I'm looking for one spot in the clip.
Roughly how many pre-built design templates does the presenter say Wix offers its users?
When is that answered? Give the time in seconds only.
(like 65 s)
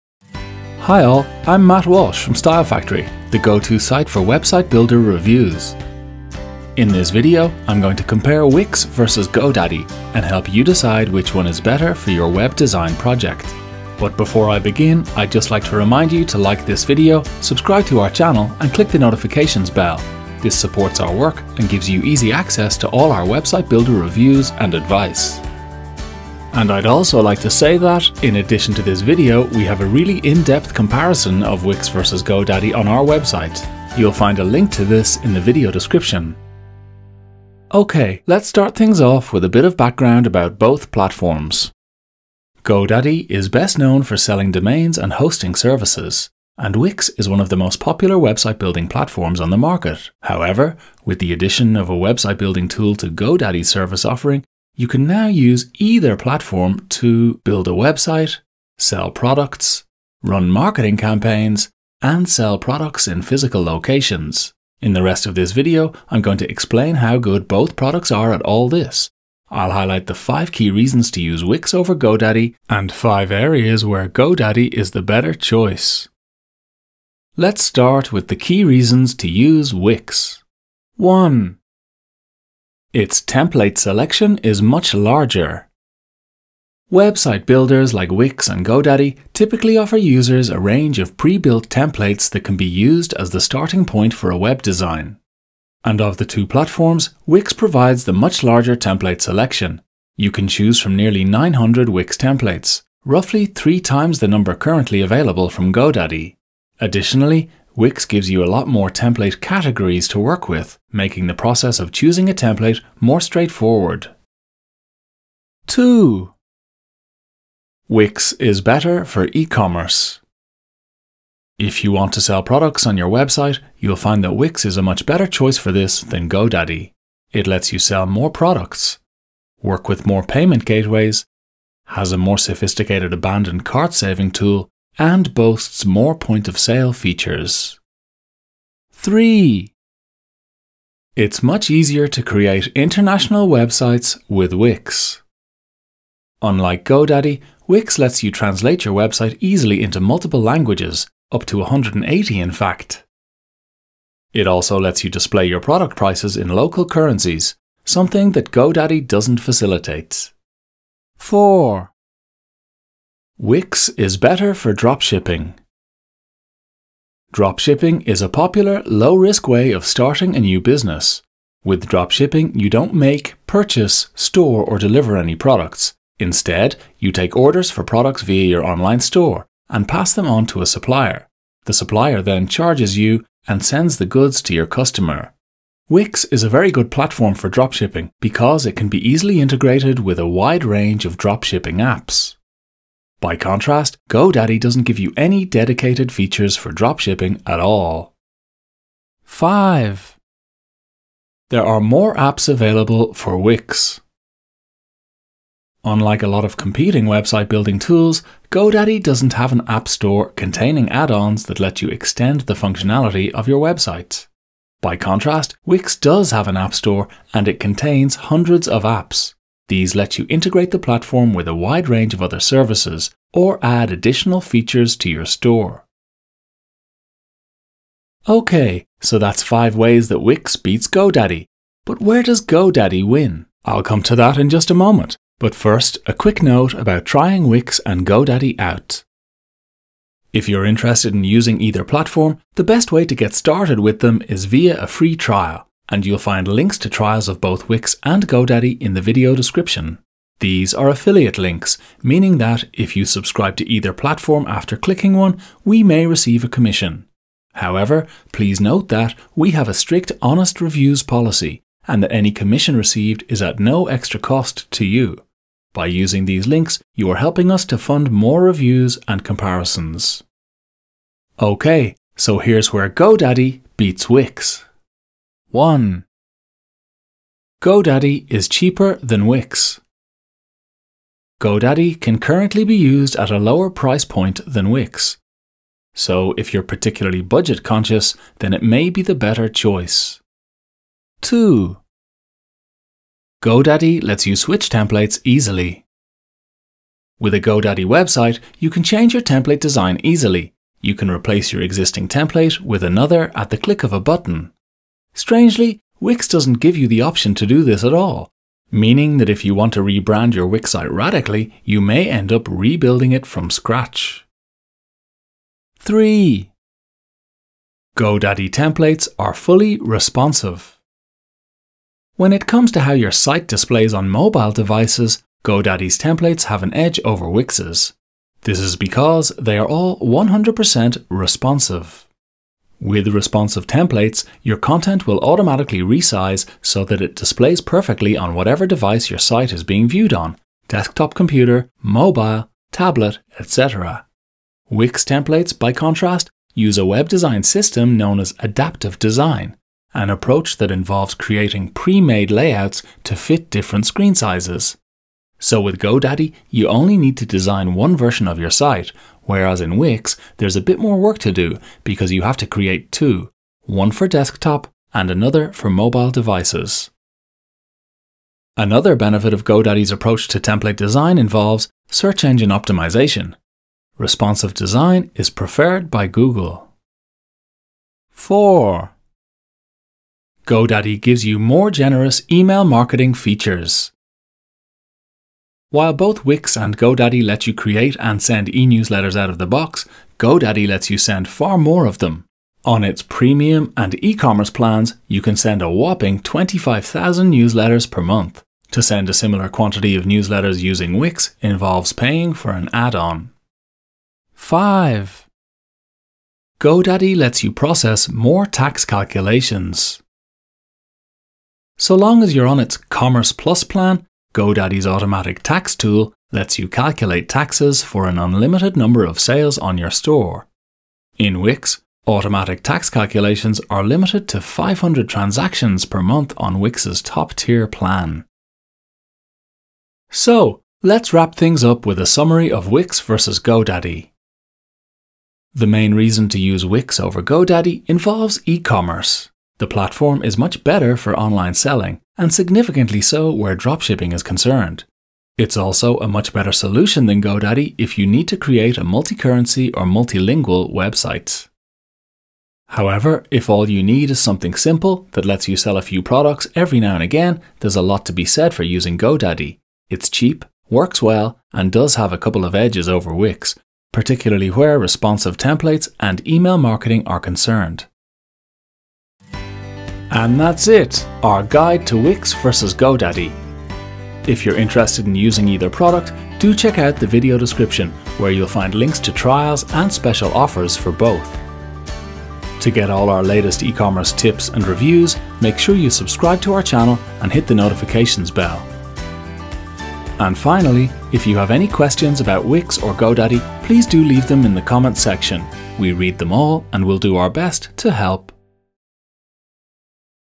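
100 s.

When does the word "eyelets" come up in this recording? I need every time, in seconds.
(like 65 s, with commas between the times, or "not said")
not said.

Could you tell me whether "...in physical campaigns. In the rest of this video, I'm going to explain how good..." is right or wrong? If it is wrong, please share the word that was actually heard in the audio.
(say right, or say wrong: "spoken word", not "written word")
wrong: "locations", not "campaigns".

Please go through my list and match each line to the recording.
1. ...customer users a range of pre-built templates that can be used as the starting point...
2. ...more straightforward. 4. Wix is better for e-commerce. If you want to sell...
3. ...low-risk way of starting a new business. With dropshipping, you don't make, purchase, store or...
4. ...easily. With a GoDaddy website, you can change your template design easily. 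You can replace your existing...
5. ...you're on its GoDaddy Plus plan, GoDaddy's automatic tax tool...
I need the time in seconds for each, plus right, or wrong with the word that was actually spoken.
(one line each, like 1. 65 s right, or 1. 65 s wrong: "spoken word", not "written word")
1. 89 s wrong: "offer", not "customer"
2. 112 s wrong: "2", not "4"
3. 168 s right
4. 295 s right
5. 412 s wrong: "Commerce", not "GoDaddy".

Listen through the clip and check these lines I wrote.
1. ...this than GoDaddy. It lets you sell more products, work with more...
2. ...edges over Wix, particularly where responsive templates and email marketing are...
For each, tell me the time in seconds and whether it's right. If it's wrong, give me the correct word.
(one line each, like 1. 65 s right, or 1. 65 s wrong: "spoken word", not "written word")
1. 125 s right
2. 462 s right.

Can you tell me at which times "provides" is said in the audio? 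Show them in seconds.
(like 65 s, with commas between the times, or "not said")
97 s.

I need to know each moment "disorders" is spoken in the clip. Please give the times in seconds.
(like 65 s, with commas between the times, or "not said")
not said.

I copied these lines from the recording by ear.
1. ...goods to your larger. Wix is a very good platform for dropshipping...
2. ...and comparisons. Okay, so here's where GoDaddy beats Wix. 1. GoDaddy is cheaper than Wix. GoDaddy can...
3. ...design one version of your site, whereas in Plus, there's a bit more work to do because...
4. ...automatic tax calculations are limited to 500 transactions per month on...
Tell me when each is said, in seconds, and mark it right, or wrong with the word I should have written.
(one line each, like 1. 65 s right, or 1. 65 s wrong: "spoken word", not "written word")
1. 184 s wrong: "customer", not "larger"
2. 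269 s right
3. 357 s wrong: "Wix", not "Plus"
4. 422 s right.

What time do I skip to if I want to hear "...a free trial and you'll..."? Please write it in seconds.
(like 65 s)
244 s.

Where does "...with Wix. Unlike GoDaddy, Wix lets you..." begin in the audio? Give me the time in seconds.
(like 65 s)
144 s.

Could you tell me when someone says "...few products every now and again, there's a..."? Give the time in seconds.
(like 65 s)
455 s.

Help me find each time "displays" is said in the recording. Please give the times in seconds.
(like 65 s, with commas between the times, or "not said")
155 s, 323 s, 337 s.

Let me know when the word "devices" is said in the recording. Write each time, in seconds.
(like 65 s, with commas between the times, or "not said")
324 s, 338 s, 366 s.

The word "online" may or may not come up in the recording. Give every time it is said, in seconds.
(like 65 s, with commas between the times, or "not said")
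178 s, 441 s.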